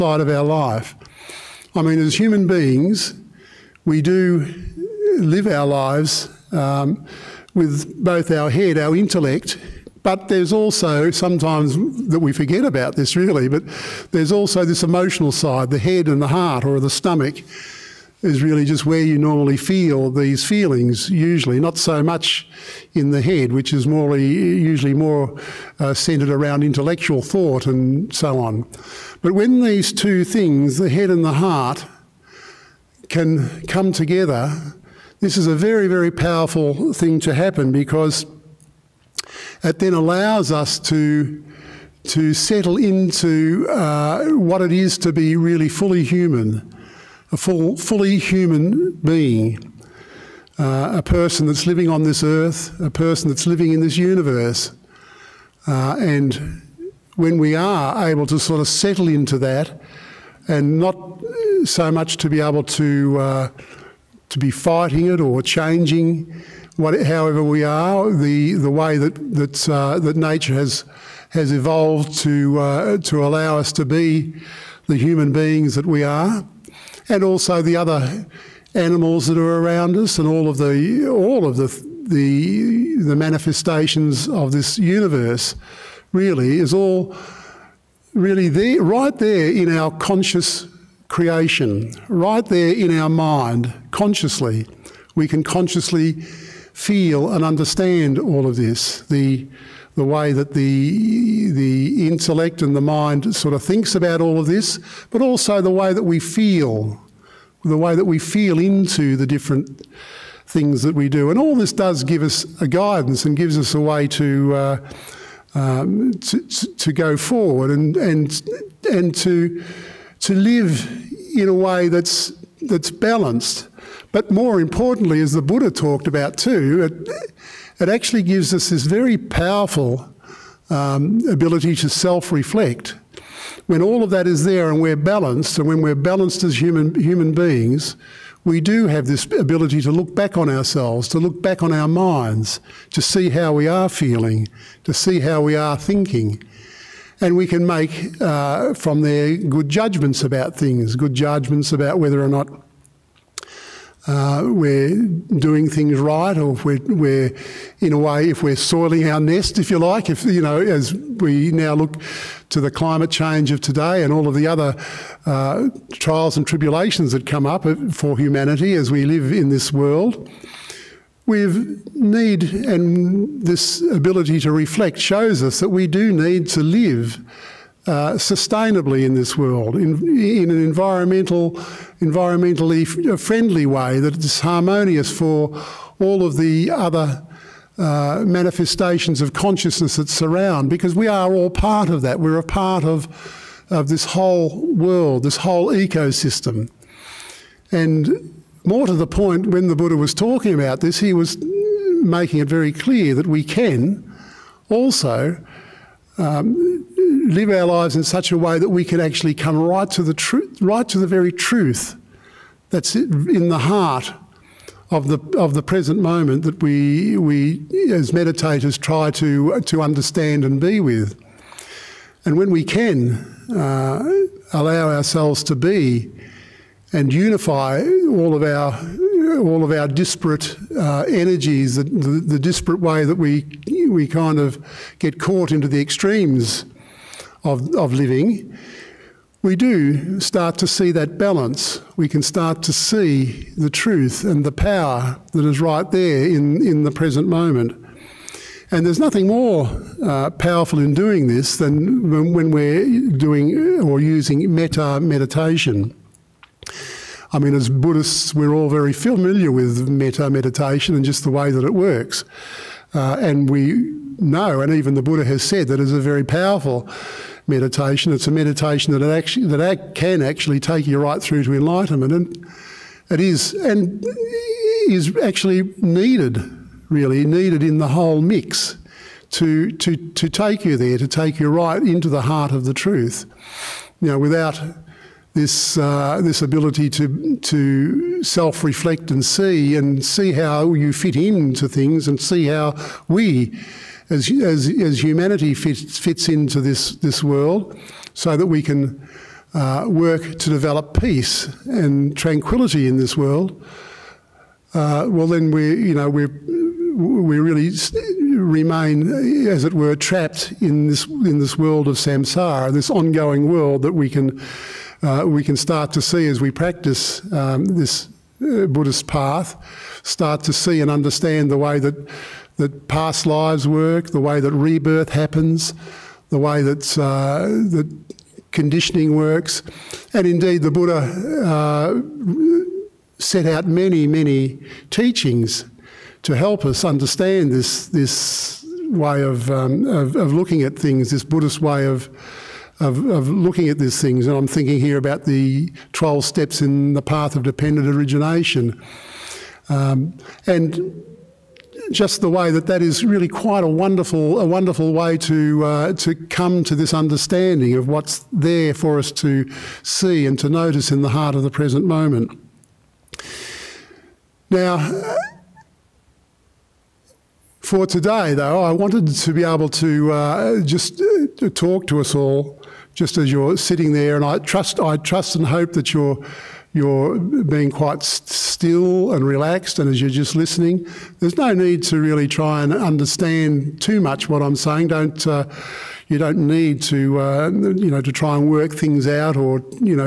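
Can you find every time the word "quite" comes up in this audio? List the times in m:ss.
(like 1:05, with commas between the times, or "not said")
5:53, 6:17.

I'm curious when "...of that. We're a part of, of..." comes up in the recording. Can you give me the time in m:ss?
3:11.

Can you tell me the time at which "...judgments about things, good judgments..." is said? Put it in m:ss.
2:29.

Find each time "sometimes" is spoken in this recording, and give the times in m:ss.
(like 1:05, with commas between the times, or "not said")
0:11.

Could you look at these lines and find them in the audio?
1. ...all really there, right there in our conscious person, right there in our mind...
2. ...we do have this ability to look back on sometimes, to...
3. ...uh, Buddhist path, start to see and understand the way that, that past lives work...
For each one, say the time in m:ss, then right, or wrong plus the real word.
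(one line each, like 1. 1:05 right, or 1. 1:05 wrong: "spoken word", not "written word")
1. 1:26 wrong: "creation", not "person"
2. 2:18 wrong: "ourselves", not "sometimes"
3. 5:18 right.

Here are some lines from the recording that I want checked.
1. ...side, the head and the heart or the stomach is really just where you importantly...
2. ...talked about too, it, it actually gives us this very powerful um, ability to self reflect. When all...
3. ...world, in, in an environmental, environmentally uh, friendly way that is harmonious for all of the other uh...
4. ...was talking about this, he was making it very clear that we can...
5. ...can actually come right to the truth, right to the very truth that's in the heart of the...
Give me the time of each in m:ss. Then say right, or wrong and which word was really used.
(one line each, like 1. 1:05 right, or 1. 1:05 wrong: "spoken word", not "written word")
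1. 0:15 wrong: "normally", not "importantly"
2. 2:05 right
3. 2:59 right
4. 3:19 right
5. 3:28 right.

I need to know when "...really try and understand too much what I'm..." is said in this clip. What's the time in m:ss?
6:21.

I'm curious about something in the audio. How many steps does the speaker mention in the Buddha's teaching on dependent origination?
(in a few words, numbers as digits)
12.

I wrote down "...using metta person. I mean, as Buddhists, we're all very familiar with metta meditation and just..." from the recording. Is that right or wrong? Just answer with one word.
wrong.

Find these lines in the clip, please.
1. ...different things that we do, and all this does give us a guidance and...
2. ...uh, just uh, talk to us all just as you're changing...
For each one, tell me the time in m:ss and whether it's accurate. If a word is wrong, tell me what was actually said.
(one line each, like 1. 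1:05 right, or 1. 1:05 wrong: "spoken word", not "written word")
1. 1:49 right
2. 6:10 wrong: "sitting", not "changing".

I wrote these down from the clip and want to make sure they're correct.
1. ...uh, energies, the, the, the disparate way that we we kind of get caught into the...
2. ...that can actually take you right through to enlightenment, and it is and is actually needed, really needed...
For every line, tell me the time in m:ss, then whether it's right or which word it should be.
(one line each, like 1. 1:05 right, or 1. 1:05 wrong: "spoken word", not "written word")
1. 3:50 right
2. 4:29 right.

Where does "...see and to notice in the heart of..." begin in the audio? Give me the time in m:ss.
5:59.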